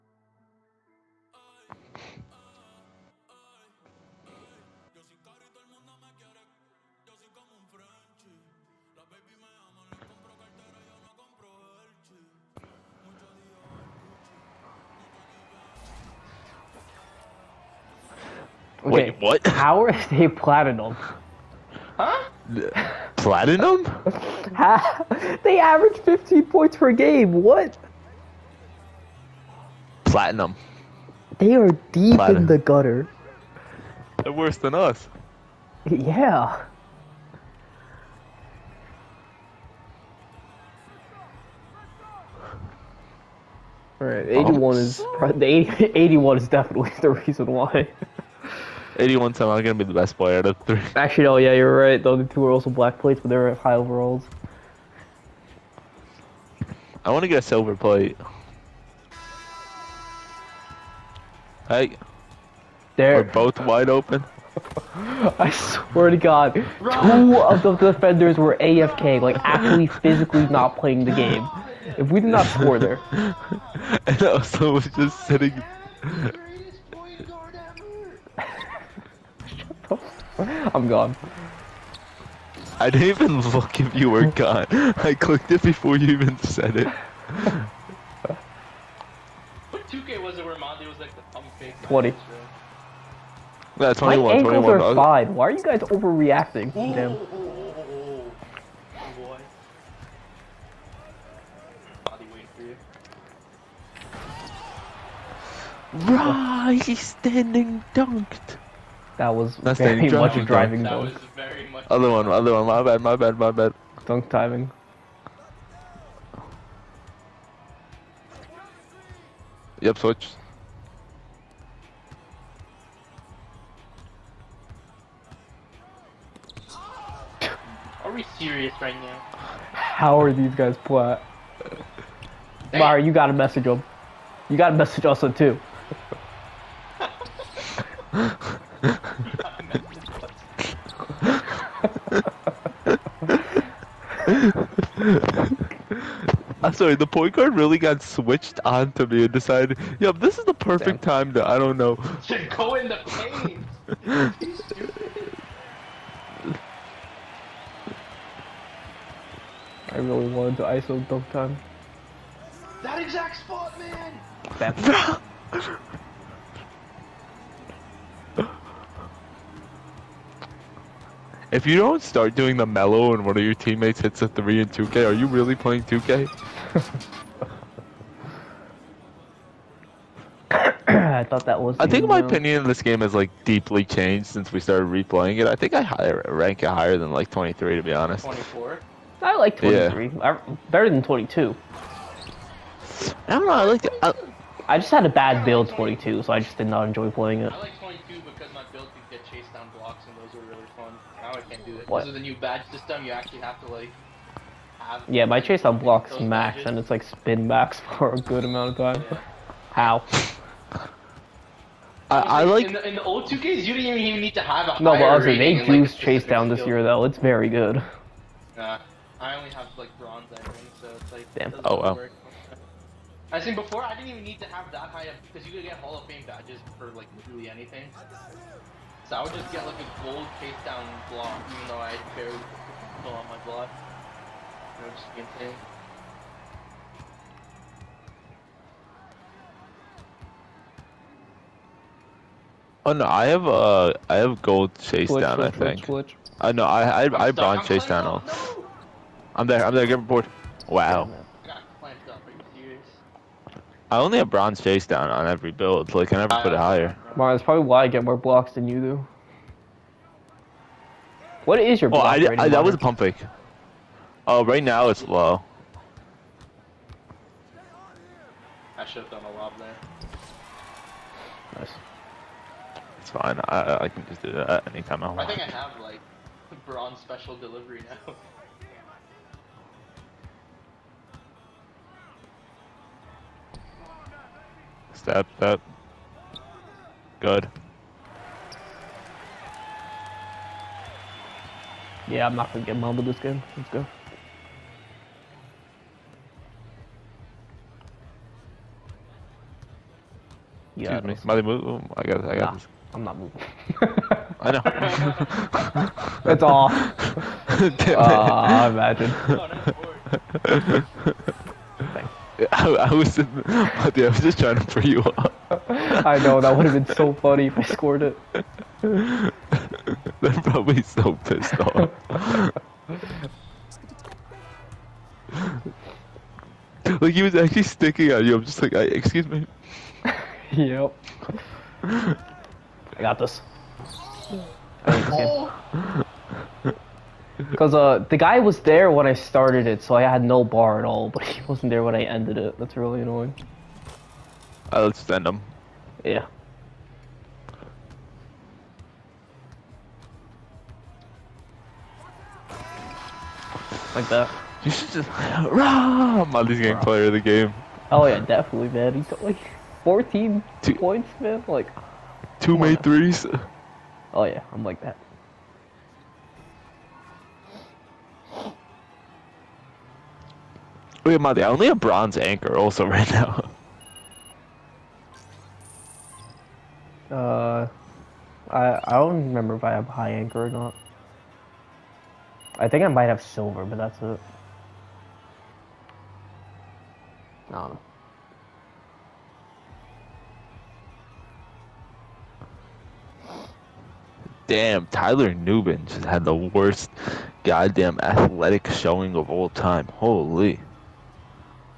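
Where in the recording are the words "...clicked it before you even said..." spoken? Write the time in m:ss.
1:25.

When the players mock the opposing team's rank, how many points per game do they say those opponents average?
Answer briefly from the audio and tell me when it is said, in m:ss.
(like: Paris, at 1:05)
15, at 0:25.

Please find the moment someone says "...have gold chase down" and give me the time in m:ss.
4:04.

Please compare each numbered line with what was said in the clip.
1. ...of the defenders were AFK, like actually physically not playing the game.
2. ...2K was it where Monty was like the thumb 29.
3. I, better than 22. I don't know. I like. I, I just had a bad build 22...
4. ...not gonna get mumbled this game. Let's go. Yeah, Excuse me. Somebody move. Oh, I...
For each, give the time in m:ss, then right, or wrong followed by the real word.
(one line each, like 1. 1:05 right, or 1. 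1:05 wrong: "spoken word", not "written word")
1. 1:07 right
2. 1:29 wrong: "20", not "29"
3. 3:10 right
4. 4:52 right.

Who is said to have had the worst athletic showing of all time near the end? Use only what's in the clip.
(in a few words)
Tyler Nubin.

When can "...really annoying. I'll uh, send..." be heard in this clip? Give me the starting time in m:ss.
5:42.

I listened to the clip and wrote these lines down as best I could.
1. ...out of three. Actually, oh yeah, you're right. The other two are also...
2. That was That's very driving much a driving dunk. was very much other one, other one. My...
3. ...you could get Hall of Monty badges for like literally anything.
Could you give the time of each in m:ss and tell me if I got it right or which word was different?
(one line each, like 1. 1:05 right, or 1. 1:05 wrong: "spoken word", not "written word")
1. 0:50 right
2. 1:49 right
3. 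3:45 wrong: "Fame", not "Monty".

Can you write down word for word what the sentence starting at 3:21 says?
Because of the new badge system, you actually have to like.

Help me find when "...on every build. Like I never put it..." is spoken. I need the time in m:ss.
4:15.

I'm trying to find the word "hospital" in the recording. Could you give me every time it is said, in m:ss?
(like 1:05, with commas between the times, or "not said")
not said.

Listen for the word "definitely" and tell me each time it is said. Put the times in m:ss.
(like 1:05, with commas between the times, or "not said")
0:46, 5:58.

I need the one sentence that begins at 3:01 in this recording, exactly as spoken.
I think my opinion of this game has like deeply changed since we started replaying it.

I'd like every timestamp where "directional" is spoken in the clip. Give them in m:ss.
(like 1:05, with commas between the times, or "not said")
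not said.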